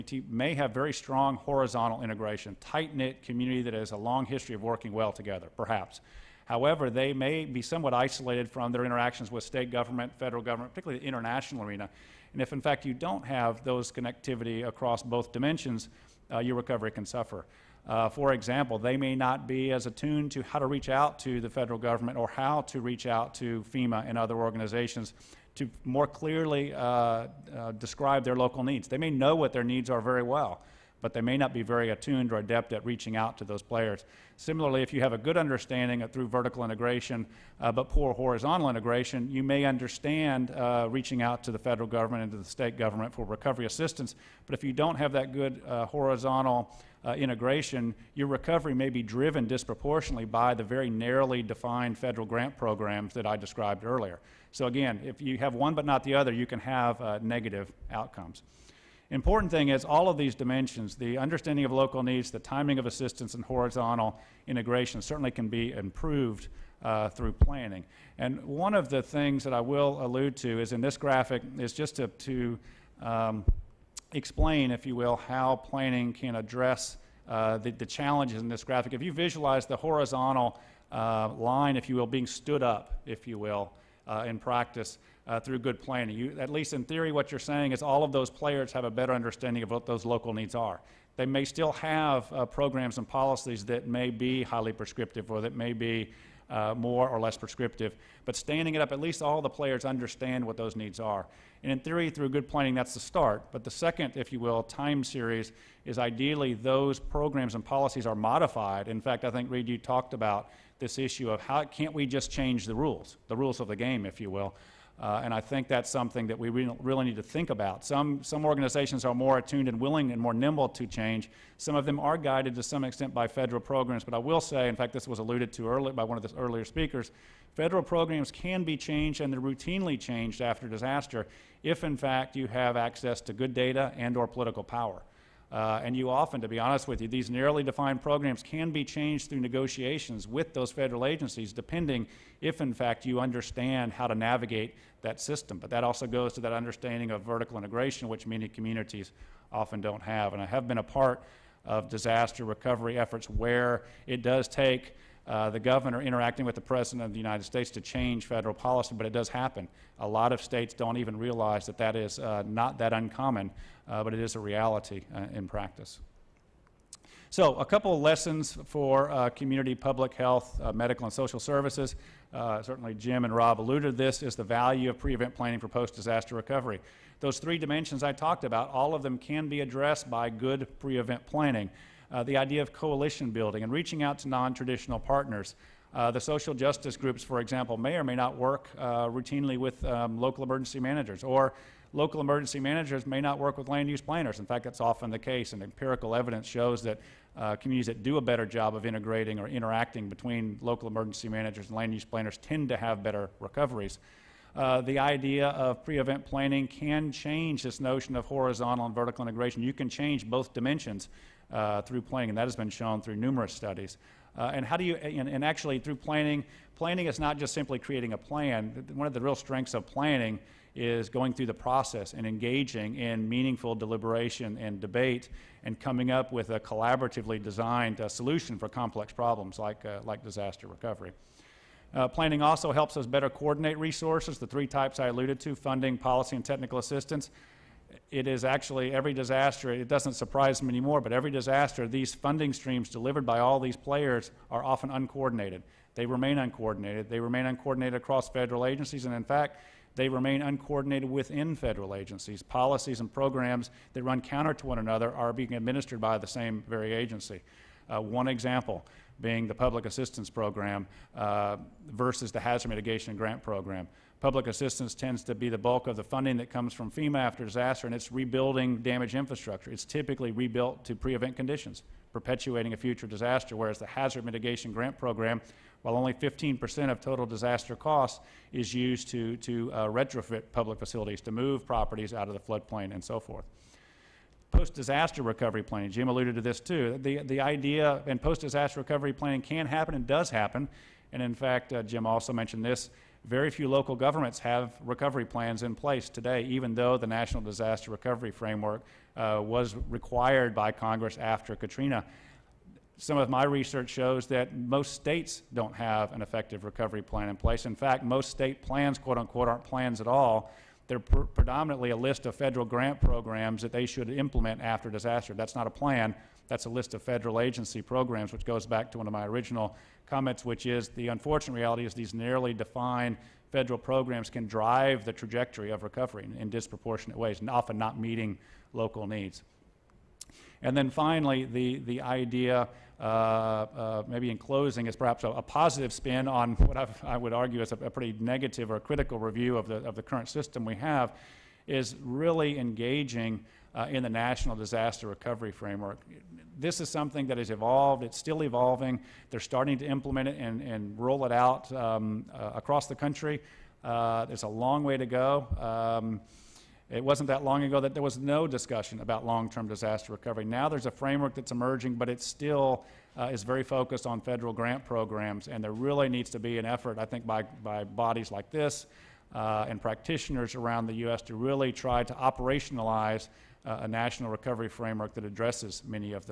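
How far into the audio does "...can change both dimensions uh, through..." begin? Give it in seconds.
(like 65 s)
209 s.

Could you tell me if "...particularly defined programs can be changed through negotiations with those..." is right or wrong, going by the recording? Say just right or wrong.
wrong.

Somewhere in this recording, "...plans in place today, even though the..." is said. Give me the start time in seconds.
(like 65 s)
295 s.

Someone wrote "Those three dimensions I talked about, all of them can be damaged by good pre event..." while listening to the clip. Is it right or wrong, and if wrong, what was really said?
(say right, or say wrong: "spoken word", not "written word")
wrong: "addressed", not "damaged".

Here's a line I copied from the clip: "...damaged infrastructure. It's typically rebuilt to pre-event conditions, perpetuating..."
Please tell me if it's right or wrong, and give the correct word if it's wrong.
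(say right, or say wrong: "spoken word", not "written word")
right.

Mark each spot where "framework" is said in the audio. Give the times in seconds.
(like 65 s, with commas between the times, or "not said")
298 s, 345 s, 360 s, 374 s.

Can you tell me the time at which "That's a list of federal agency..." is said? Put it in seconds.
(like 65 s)
316 s.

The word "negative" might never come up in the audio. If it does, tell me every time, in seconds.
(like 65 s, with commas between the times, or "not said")
57 s, 338 s.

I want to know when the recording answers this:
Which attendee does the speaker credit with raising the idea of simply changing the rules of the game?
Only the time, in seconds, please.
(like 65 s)
109 s.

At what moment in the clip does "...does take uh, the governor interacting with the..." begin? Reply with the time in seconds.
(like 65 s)
154 s.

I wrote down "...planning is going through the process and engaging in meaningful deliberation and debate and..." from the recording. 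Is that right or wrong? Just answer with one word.
right.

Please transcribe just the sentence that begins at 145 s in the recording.
But that also goes to that understanding of vertical integration, which many communities often don't have.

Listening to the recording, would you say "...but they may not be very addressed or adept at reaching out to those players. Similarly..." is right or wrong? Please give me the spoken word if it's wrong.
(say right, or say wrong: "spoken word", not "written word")
wrong: "attuned", not "addressed".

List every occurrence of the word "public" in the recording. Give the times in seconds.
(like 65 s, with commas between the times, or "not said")
169 s, 259 s, 264 s, 280 s.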